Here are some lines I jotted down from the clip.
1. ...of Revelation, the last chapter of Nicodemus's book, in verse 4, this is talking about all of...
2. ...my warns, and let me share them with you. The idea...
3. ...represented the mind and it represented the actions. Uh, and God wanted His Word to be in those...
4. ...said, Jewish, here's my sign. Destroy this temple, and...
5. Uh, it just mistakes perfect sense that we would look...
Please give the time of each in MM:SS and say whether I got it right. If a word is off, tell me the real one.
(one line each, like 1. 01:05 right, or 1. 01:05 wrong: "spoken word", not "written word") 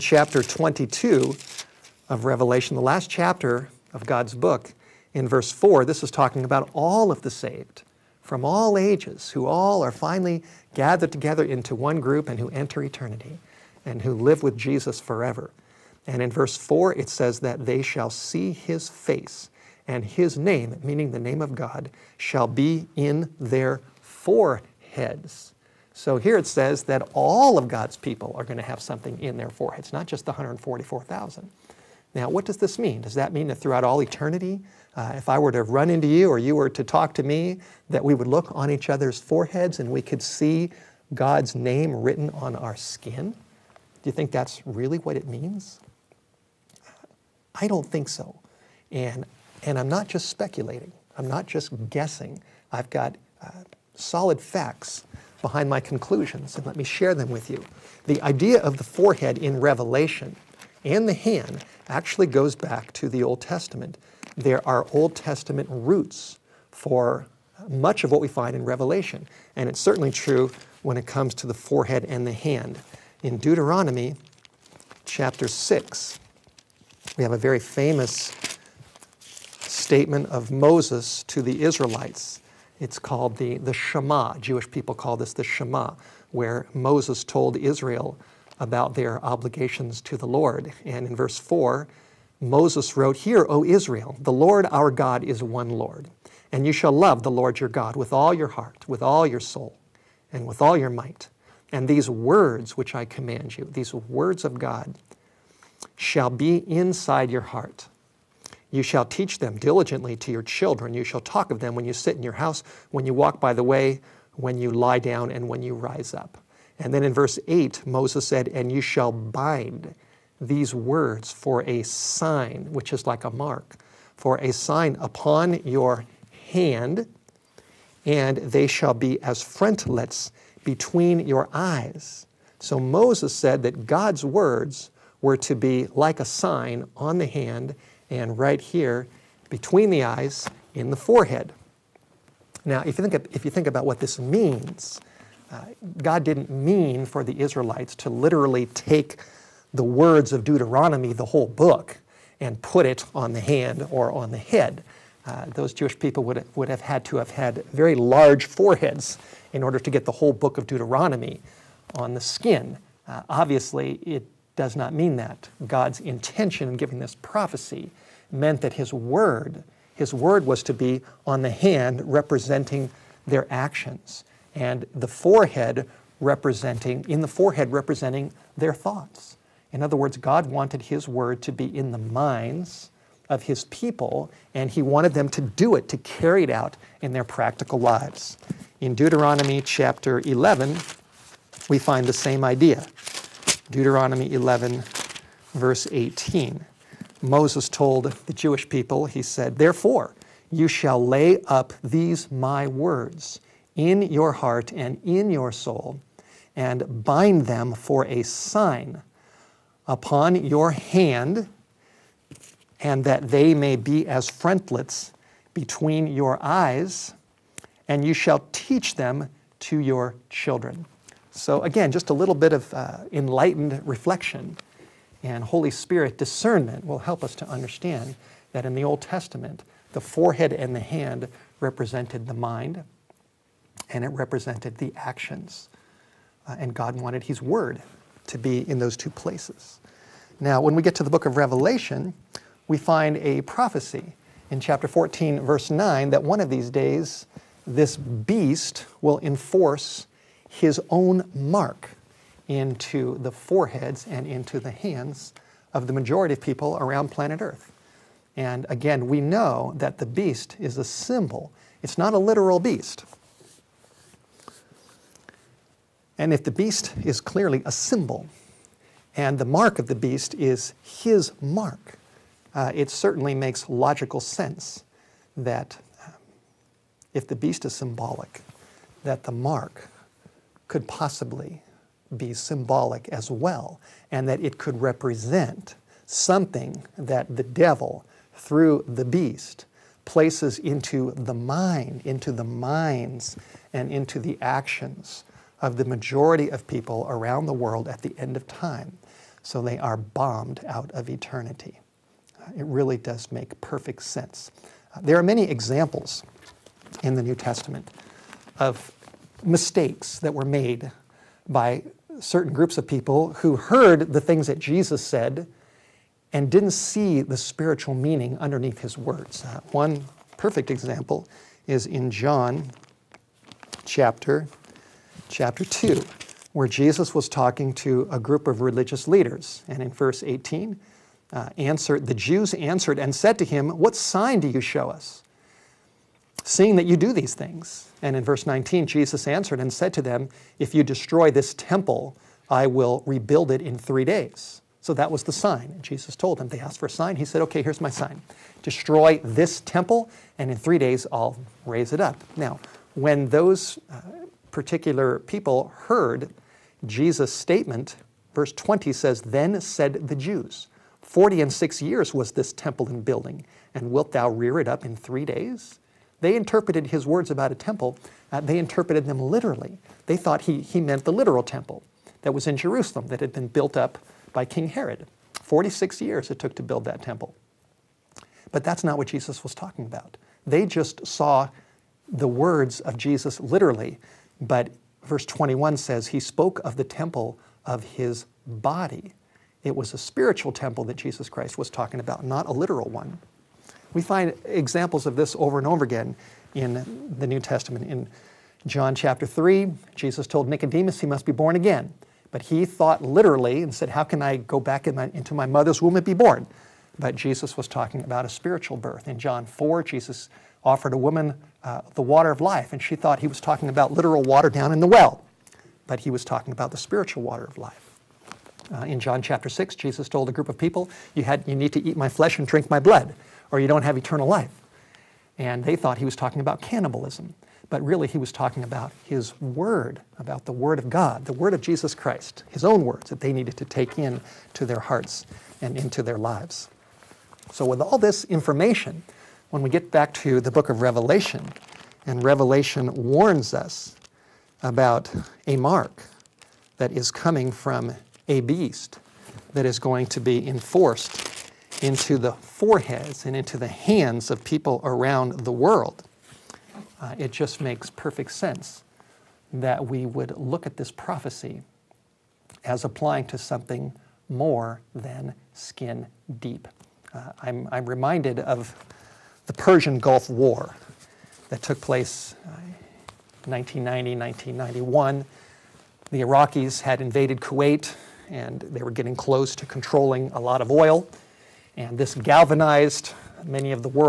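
1. 00:02 wrong: "God", not "Nicodemus"
2. 00:55 wrong: "conclusions", not "warns"
3. 03:51 right
4. 05:47 wrong: "Okay", not "Jewish"
5. 07:36 wrong: "makes", not "mistakes".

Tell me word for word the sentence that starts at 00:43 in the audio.
Do you think that's really what it means?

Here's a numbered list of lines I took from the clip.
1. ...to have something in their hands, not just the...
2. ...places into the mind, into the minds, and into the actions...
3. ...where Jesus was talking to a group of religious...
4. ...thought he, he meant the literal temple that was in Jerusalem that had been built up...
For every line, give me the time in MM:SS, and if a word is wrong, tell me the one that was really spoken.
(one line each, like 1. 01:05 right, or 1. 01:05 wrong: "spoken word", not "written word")
1. 00:28 wrong: "foreheads", not "hands"
2. 04:50 right
3. 05:26 right
4. 06:10 right.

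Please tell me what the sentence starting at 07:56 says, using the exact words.
The Iraqis had invaded Kuwait and they were getting close to controlling a lot of oil.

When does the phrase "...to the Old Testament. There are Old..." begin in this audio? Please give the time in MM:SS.
01:02.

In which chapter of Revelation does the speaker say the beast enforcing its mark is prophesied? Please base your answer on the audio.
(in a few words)
14.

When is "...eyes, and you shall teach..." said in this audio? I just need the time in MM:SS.
03:36.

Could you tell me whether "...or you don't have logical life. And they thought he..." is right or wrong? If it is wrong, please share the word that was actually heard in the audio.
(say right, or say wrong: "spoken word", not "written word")
wrong: "eternal", not "logical".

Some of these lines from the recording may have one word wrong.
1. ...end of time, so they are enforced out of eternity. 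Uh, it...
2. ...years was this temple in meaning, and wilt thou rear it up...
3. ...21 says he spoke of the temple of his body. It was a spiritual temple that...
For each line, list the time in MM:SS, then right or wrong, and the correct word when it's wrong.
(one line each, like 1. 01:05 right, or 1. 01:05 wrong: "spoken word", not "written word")
1. 04:58 wrong: "bombed", not "enforced"
2. 06:01 wrong: "building", not "meaning"
3. 06:25 right.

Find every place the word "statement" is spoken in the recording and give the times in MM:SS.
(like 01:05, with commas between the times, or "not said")
01:19, 05:57.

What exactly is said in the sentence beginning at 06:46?
But Jesus was talking about a spiritual birth.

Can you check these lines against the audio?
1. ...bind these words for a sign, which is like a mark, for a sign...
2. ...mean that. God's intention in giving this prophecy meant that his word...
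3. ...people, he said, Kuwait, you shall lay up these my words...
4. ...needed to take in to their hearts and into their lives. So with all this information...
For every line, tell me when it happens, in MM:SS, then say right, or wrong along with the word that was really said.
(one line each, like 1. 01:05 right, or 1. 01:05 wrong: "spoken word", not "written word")
1. 01:59 right
2. 02:44 right
3. 03:18 wrong: "Therefore", not "Kuwait"
4. 07:13 right.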